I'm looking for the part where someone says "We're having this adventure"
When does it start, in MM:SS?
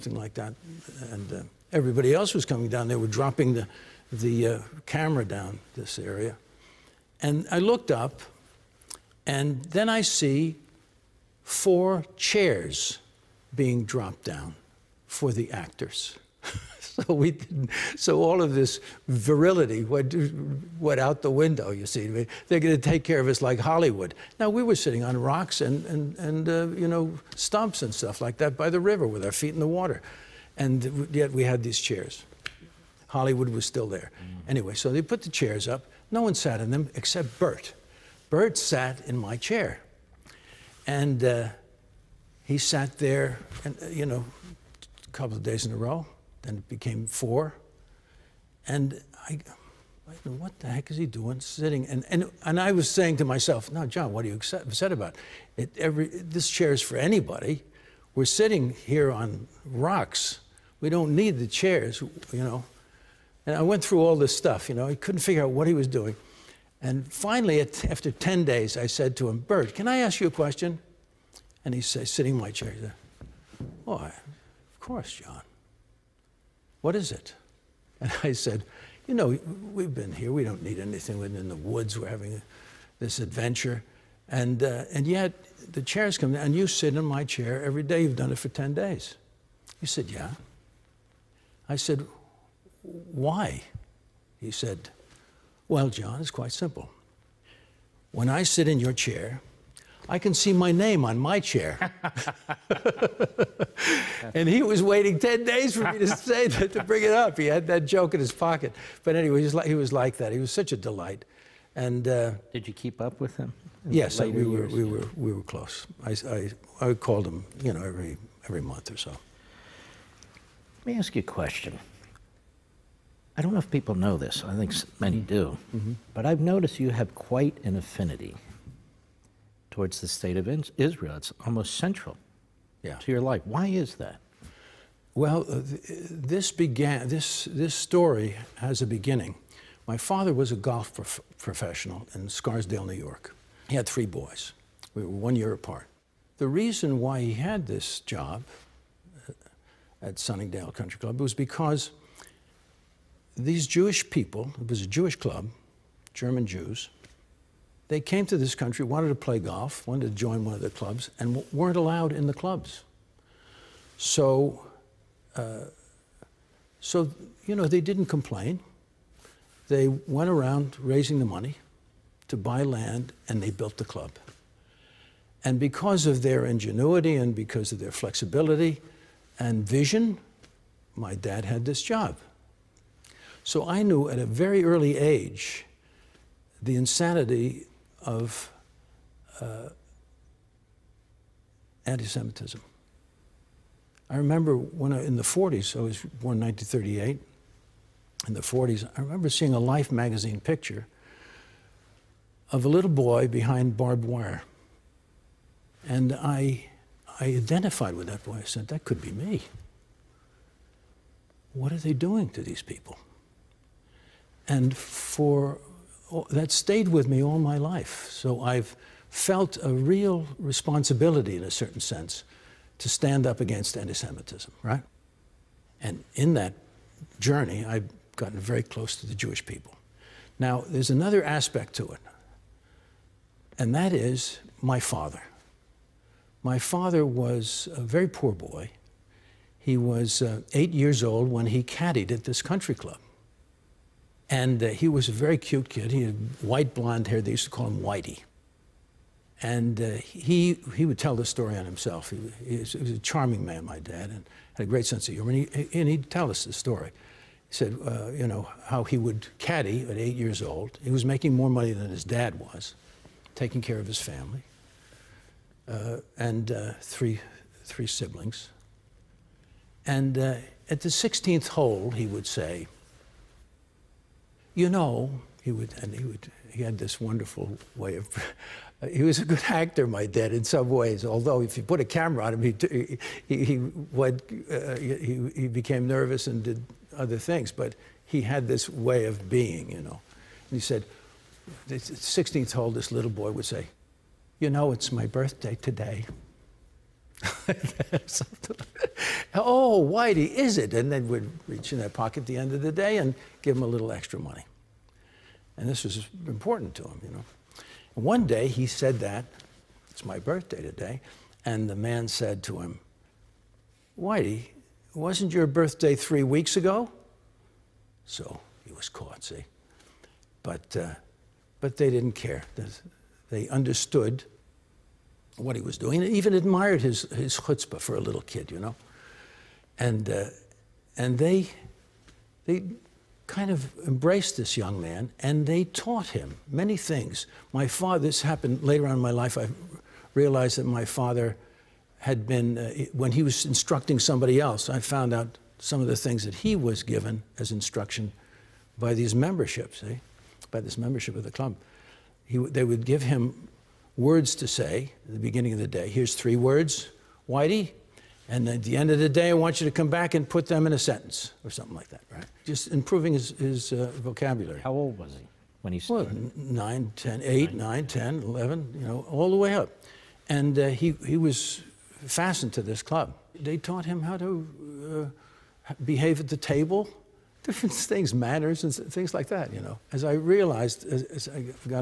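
01:21.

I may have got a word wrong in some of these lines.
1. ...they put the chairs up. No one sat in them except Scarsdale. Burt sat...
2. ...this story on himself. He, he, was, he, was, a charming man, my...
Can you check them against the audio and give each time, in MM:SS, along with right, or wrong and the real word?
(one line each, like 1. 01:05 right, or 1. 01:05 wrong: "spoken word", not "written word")
1. 00:34 wrong: "Burt", not "Scarsdale"
2. 04:11 right.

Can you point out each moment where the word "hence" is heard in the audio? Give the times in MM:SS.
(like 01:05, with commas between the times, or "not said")
not said.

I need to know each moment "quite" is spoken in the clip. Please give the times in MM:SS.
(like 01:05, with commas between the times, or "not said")
01:36, 02:07.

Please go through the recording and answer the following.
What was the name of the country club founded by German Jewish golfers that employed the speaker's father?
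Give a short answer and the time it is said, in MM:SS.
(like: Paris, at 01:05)
Sunningdale Country Club, at 02:30.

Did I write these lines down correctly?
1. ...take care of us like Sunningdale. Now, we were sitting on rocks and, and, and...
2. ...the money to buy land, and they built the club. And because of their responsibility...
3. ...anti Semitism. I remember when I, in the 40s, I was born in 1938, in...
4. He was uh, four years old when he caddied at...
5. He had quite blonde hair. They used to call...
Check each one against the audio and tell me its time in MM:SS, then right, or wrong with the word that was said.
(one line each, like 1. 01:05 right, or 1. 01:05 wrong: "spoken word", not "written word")
1. 00:22 wrong: "Hollywood", not "Sunningdale"
2. 02:51 wrong: "ingenuity", not "responsibility"
3. 03:11 right
4. 03:59 wrong: "eight", not "four"
5. 04:05 wrong: "white", not "quite".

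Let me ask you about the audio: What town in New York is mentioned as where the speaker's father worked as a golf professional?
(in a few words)
Scarsdale.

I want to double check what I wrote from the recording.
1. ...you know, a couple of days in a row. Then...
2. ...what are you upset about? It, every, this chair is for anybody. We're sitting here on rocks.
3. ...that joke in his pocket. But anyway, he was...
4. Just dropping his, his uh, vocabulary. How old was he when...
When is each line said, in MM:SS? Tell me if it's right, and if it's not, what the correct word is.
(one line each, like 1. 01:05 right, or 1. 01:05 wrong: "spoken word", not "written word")
1. 00:43 right
2. 00:54 right
3. 01:47 right
4. 06:02 wrong: "improving", not "dropping".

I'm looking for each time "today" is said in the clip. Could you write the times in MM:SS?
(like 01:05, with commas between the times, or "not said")
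04:55, 05:10.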